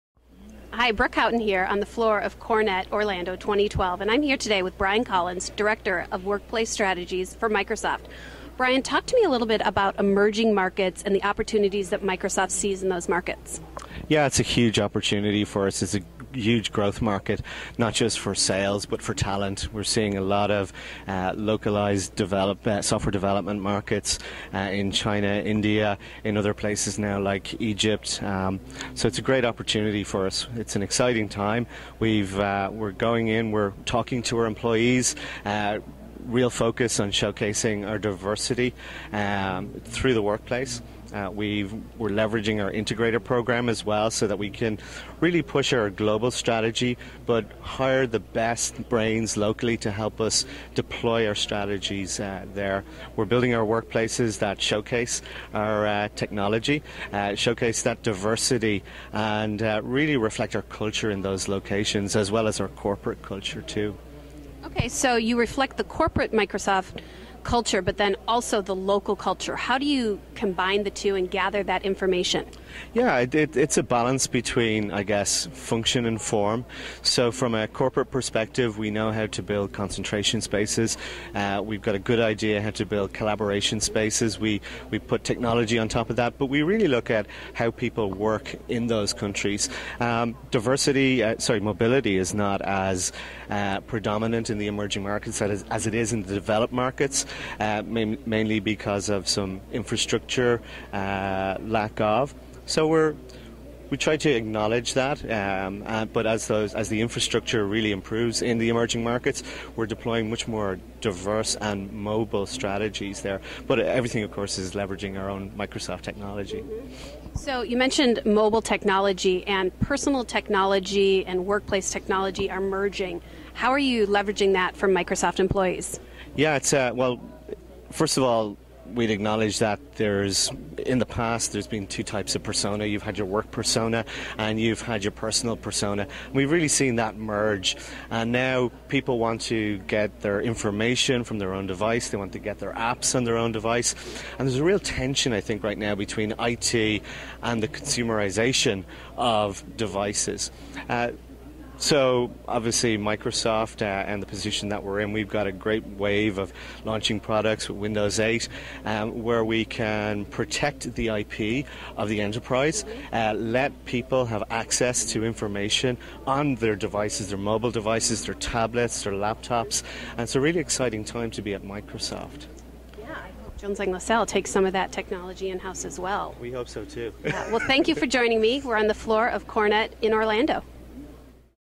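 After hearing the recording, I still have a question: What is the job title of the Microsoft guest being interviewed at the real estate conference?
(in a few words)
Director of Workplace Strategies.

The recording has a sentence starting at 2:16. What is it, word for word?
We've really seen that merge, and now people want to get their information from their own device.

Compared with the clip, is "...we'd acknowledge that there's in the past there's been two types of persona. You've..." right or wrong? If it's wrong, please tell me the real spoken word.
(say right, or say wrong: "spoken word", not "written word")
right.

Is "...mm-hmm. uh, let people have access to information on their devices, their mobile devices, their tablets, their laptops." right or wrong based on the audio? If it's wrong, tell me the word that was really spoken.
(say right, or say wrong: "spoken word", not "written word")
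right.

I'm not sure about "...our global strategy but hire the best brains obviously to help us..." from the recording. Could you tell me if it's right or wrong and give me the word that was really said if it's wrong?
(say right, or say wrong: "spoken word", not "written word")
wrong: "locally", not "obviously".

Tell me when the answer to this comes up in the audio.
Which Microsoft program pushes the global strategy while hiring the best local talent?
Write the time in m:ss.
0:42.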